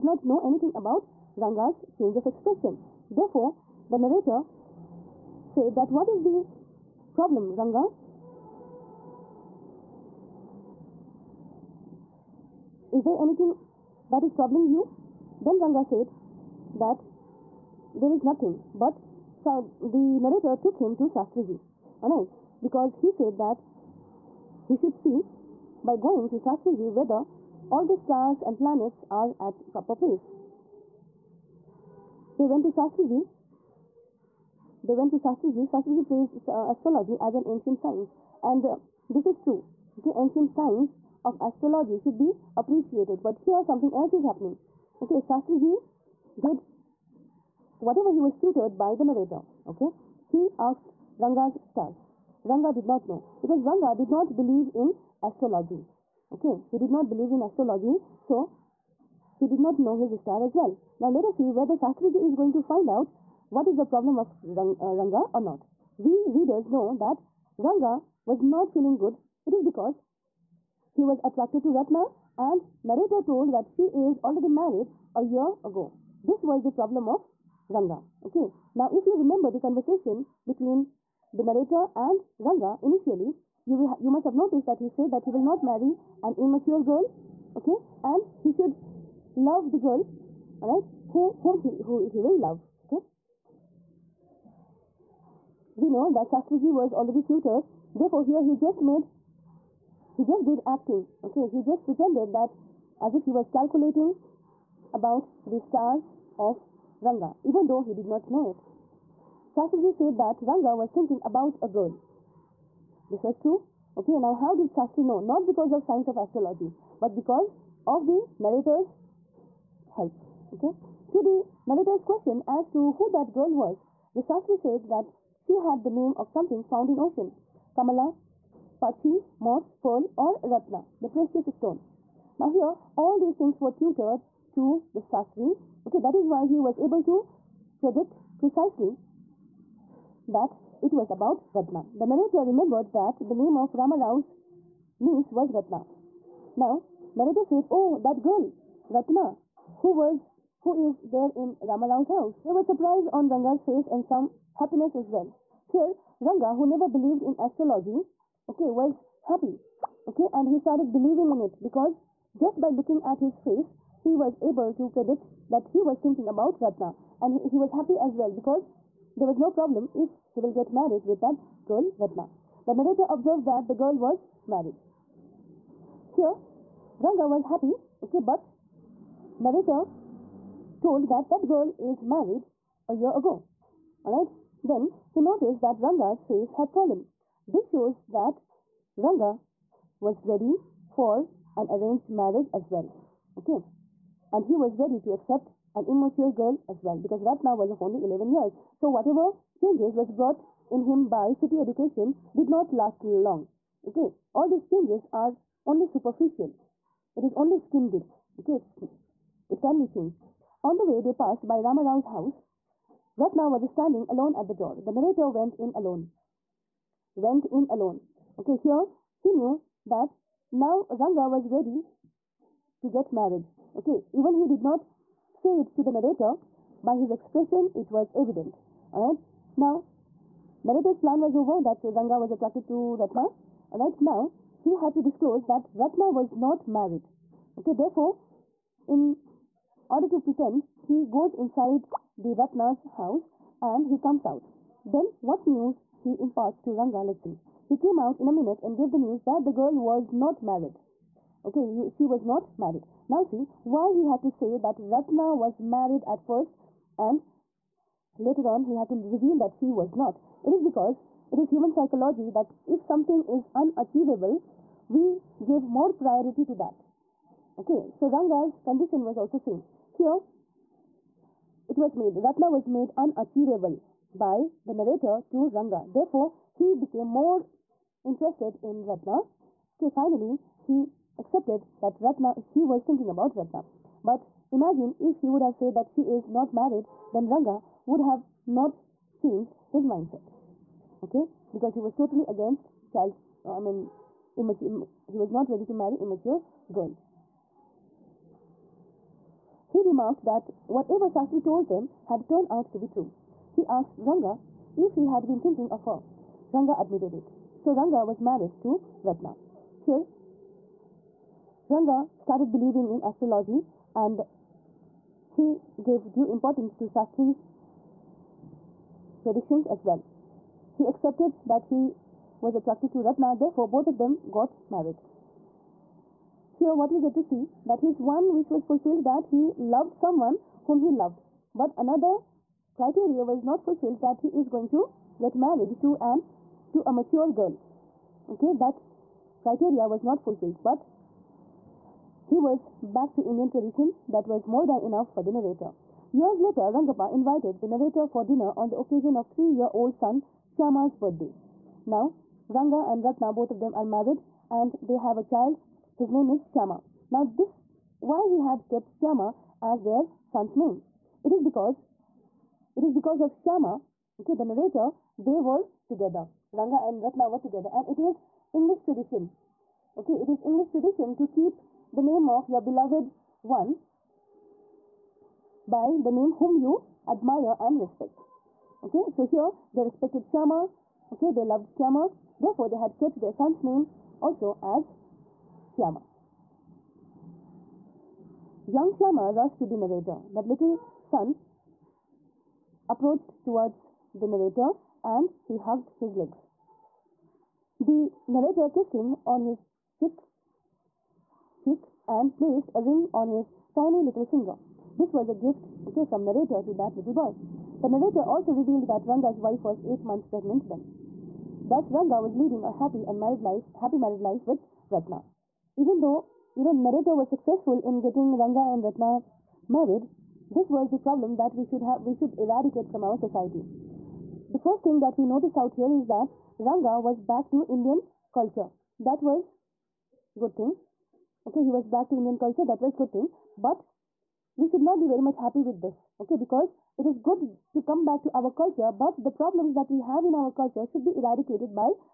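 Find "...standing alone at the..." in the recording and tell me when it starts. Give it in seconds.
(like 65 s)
213 s.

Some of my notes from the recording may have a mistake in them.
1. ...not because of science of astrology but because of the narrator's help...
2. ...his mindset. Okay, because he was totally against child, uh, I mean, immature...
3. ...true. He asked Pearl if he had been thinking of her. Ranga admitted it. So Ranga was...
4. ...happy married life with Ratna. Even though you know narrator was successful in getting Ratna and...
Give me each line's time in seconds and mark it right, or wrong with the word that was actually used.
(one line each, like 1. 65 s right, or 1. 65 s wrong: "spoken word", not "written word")
1. 115 s right
2. 289 s right
3. 302 s wrong: "Ranga", not "Pearl"
4. 413 s wrong: "Ranga", not "Ratna".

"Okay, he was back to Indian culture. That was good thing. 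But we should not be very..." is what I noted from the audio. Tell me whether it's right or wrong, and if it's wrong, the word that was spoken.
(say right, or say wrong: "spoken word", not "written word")
right.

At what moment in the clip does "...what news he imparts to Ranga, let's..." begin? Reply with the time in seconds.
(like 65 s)
245 s.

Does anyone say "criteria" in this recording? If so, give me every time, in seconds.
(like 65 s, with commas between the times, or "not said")
332 s, 339 s.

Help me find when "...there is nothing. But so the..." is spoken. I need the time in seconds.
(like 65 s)
17 s.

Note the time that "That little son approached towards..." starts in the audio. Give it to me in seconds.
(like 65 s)
390 s.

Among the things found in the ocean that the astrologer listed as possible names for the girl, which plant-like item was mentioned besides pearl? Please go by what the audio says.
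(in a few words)
Moss.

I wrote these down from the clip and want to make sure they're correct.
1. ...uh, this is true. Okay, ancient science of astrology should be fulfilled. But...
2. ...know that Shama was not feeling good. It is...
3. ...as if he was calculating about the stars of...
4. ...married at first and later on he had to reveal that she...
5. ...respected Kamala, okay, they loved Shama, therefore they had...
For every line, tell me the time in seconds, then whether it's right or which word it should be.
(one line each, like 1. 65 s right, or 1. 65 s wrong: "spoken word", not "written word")
1. 38 s wrong: "appreciated", not "fulfilled"
2. 66 s wrong: "Ranga", not "Shama"
3. 103 s right
4. 255 s right
5. 379 s wrong: "Shama", not "Kamala".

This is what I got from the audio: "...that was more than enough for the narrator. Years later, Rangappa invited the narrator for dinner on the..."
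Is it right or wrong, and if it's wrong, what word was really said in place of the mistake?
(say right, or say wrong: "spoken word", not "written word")
right.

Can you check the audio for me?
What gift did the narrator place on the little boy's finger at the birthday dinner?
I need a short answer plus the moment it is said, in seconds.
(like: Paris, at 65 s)
A ring, at 402 s.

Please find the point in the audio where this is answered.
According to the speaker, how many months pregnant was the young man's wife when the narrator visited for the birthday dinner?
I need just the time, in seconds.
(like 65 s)
409 s.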